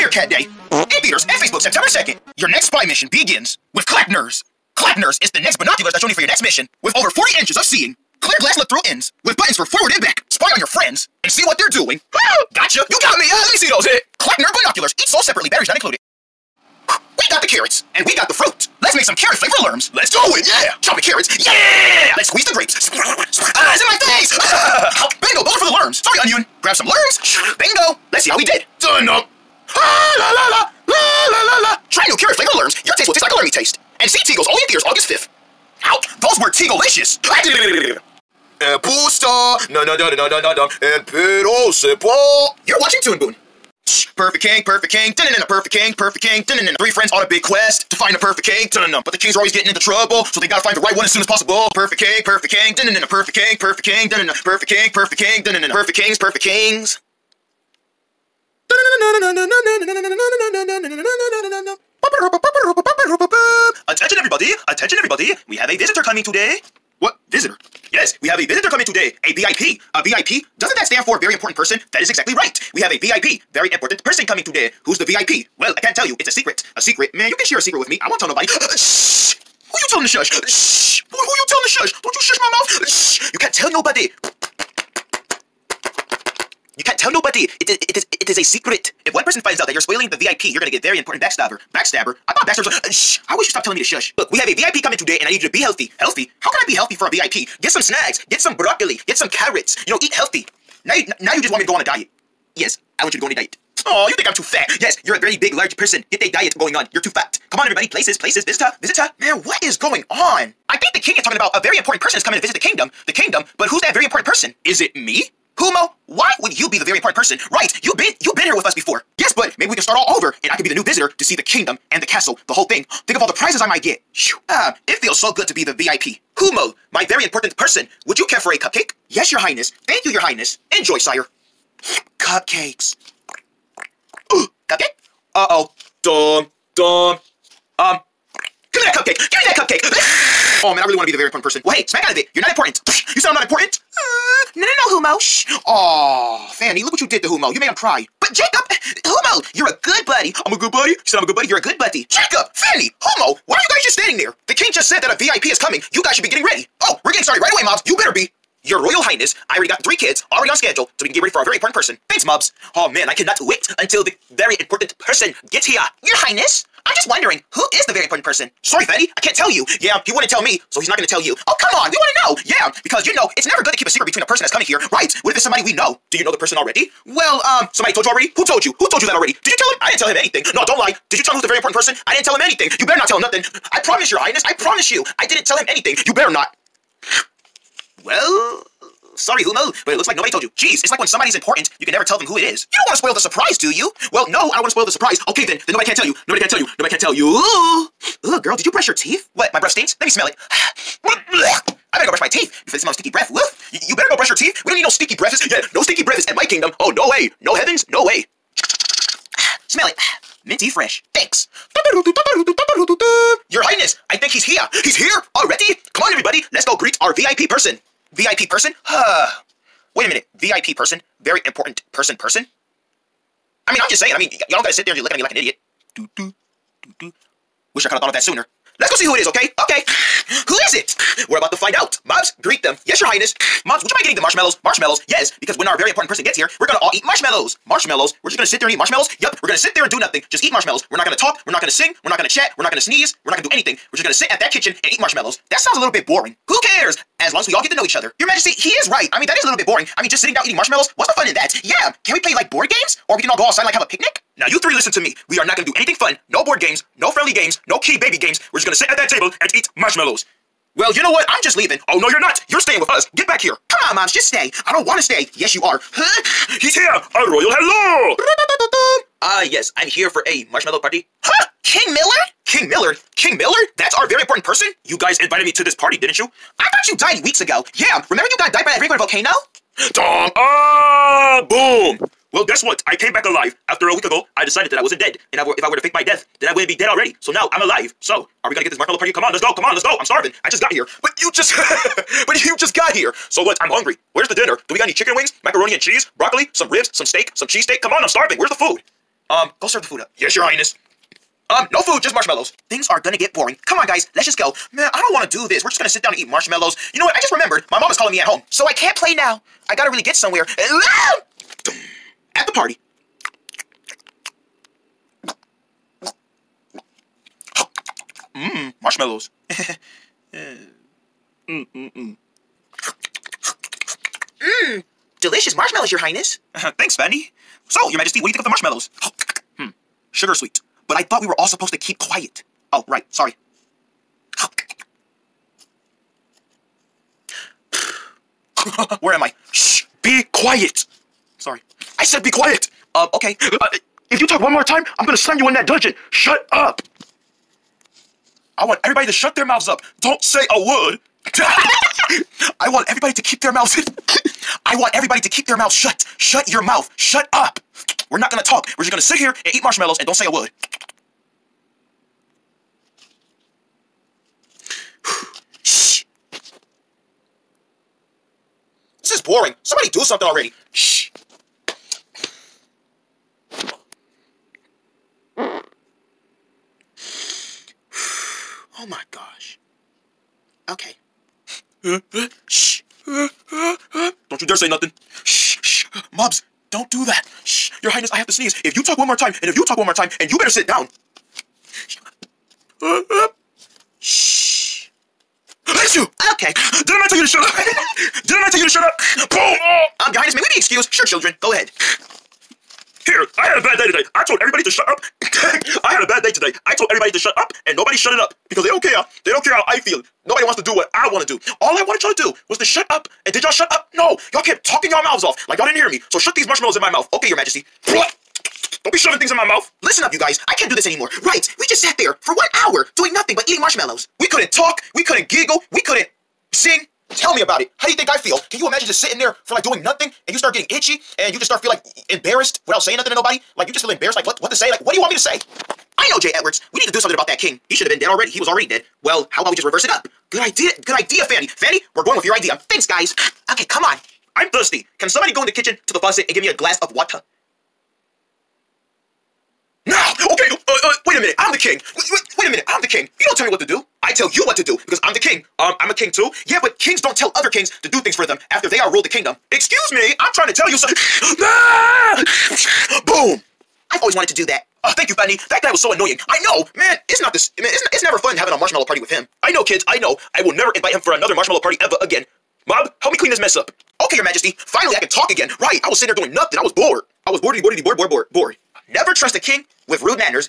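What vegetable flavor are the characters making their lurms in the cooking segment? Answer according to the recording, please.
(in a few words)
carrot.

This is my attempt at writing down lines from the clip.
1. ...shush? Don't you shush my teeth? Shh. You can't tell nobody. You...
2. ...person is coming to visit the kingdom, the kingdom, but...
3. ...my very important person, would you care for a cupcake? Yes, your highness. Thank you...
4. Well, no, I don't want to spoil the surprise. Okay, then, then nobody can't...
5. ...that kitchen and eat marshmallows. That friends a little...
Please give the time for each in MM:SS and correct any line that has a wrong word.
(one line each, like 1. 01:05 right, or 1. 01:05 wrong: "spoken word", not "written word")
1. 01:21 wrong: "mouth", not "teeth"
2. 01:52 right
3. 02:06 right
4. 03:14 right
5. 04:04 wrong: "sounds", not "friends".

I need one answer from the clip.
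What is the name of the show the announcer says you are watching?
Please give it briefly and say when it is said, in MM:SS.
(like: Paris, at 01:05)
Toon Boon, at 00:43.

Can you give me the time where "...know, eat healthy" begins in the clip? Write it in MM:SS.
01:39.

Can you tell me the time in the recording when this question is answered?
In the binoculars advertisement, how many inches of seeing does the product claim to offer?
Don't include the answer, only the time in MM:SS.
00:07.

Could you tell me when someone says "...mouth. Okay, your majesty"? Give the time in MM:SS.
06:56.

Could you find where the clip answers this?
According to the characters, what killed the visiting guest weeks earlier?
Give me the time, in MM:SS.
04:38.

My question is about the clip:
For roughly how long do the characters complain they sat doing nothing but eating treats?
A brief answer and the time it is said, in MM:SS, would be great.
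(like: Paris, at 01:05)
1 hour, at 07:02.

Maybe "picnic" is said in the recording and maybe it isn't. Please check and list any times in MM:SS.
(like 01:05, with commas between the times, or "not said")
04:13.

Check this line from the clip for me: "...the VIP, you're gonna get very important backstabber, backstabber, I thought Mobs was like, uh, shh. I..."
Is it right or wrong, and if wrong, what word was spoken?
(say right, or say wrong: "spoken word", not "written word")
wrong: "Baxter", not "Mobs".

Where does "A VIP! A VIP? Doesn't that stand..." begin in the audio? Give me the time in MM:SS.
01:09.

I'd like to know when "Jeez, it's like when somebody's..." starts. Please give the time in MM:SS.
03:10.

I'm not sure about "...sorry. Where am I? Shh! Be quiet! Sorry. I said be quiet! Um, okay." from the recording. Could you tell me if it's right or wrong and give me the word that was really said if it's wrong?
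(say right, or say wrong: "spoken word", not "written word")
right.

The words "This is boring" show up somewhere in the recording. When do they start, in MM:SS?
06:09.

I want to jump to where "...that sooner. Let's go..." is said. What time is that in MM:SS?
03:48.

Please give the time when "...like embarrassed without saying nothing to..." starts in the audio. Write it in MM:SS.
07:11.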